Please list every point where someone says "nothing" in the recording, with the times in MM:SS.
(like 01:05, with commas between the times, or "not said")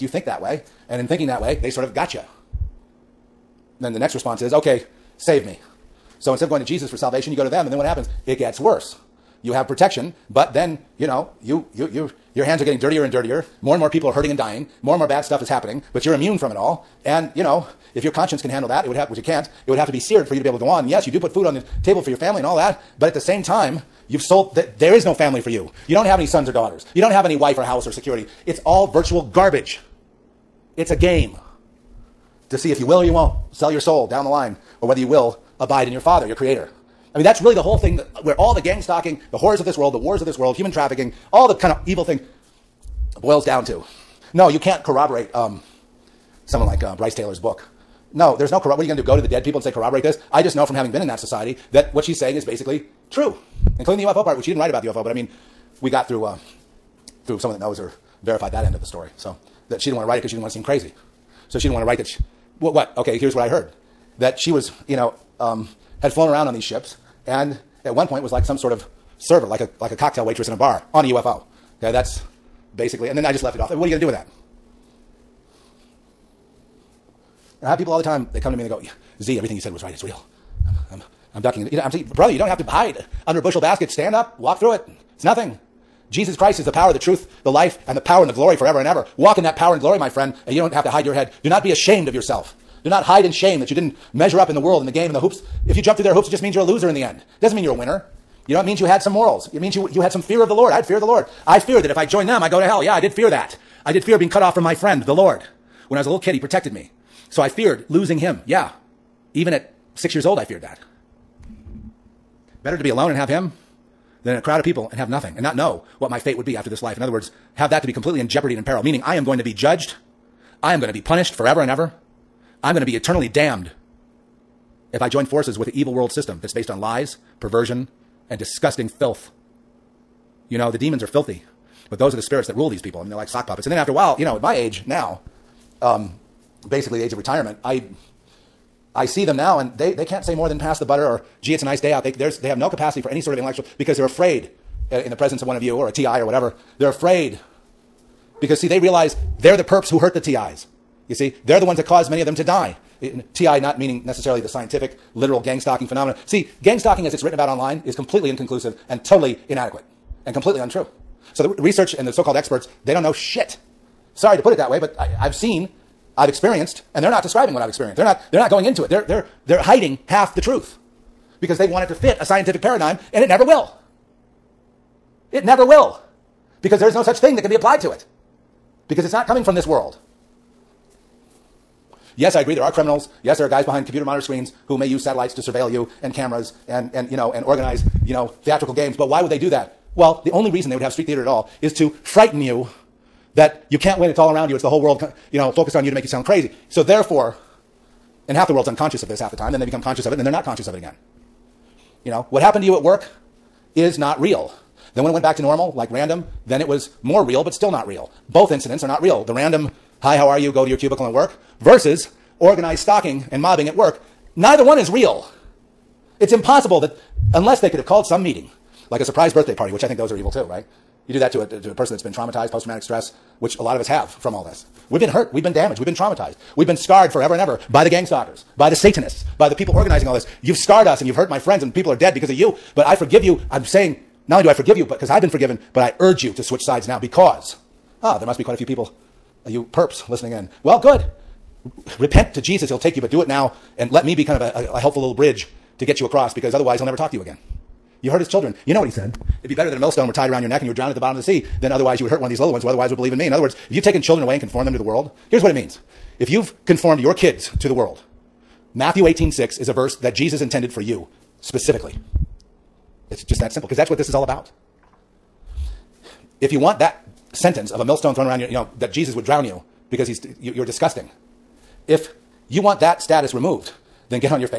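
01:25, 01:55.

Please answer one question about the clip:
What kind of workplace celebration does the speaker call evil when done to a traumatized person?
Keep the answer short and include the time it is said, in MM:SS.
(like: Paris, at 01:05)
Surprise birthday party, at 03:39.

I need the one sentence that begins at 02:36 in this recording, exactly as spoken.
See, gang stalking as it's written about online is completely inconclusive and totally inadequate and completely untrue.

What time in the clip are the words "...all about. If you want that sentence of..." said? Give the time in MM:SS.
04:24.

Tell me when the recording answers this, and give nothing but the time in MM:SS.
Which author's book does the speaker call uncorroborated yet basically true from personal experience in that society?
00:46.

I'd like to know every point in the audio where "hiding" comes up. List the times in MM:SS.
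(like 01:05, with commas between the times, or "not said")
02:49.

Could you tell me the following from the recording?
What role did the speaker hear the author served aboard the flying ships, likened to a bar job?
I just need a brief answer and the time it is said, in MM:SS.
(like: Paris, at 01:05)
Cocktail waitress, at 01:09.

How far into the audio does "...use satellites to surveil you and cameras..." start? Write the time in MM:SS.
03:04.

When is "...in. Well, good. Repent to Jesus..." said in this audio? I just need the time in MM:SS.
04:00.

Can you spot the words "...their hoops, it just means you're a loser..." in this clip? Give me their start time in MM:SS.
01:36.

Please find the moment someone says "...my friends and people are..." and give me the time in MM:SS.
03:51.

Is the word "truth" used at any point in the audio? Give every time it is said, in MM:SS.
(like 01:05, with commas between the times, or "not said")
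01:26, 02:50.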